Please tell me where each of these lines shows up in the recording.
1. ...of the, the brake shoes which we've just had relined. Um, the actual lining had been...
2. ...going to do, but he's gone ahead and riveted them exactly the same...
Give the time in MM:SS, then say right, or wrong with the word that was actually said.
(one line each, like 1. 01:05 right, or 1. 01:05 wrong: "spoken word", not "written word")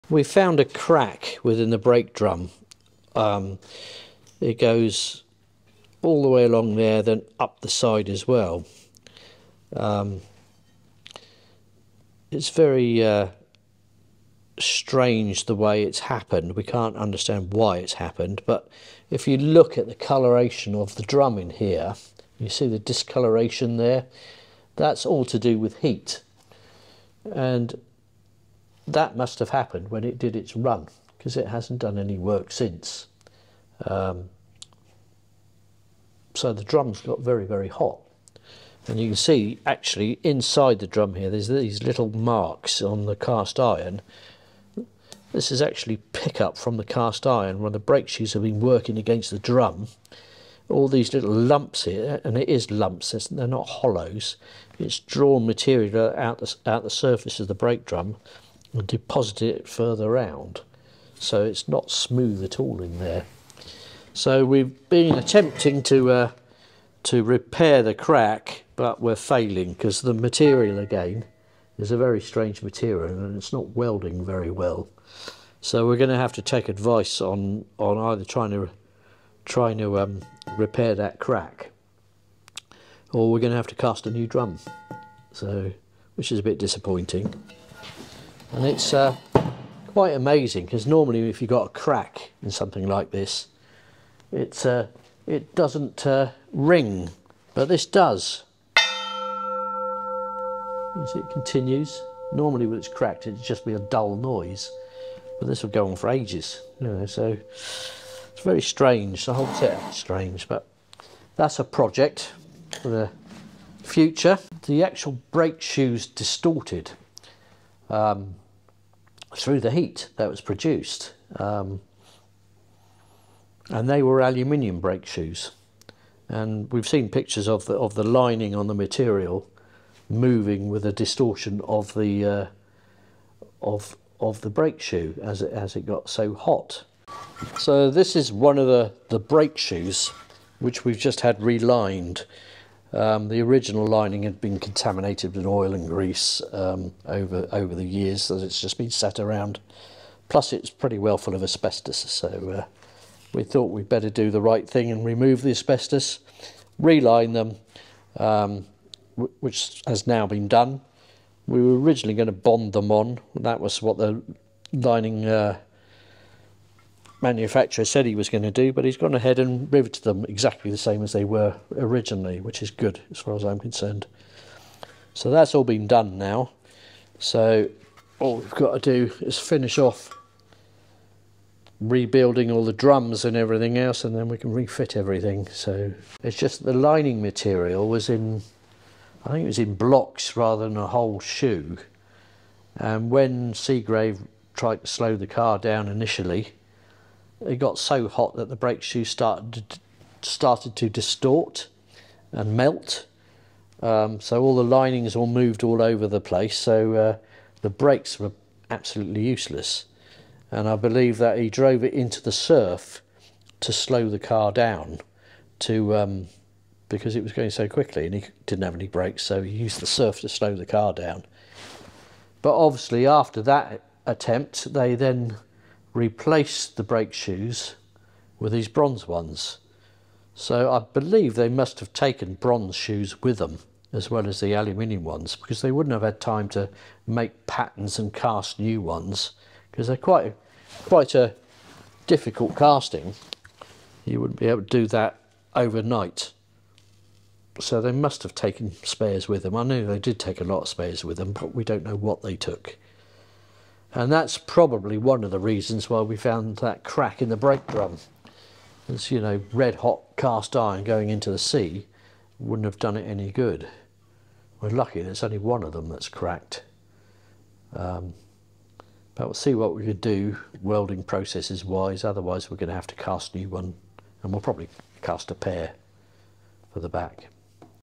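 1. 02:18 wrong: "original", not "actual"
2. 02:48 right.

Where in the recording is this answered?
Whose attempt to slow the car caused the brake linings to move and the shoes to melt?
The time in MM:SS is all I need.
03:13.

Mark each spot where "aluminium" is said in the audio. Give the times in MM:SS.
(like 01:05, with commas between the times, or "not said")
02:04, 03:54.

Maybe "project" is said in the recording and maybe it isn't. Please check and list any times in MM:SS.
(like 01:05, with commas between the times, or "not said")
01:51.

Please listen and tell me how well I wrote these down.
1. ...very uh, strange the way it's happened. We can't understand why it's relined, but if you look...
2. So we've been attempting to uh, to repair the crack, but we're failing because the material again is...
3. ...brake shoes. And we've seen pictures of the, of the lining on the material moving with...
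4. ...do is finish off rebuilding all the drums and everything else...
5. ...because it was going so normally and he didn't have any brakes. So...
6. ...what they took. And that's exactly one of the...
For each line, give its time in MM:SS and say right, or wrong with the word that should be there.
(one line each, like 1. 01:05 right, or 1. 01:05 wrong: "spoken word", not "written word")
1. 00:12 wrong: "happened", not "relined"
2. 01:04 right
3. 02:04 right
4. 02:59 right
5. 03:36 wrong: "quickly", not "normally"
6. 04:11 wrong: "probably", not "exactly".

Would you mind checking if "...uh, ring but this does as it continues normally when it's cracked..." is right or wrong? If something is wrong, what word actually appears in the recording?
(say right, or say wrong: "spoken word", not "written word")
right.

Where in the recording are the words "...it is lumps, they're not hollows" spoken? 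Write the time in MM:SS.
00:52.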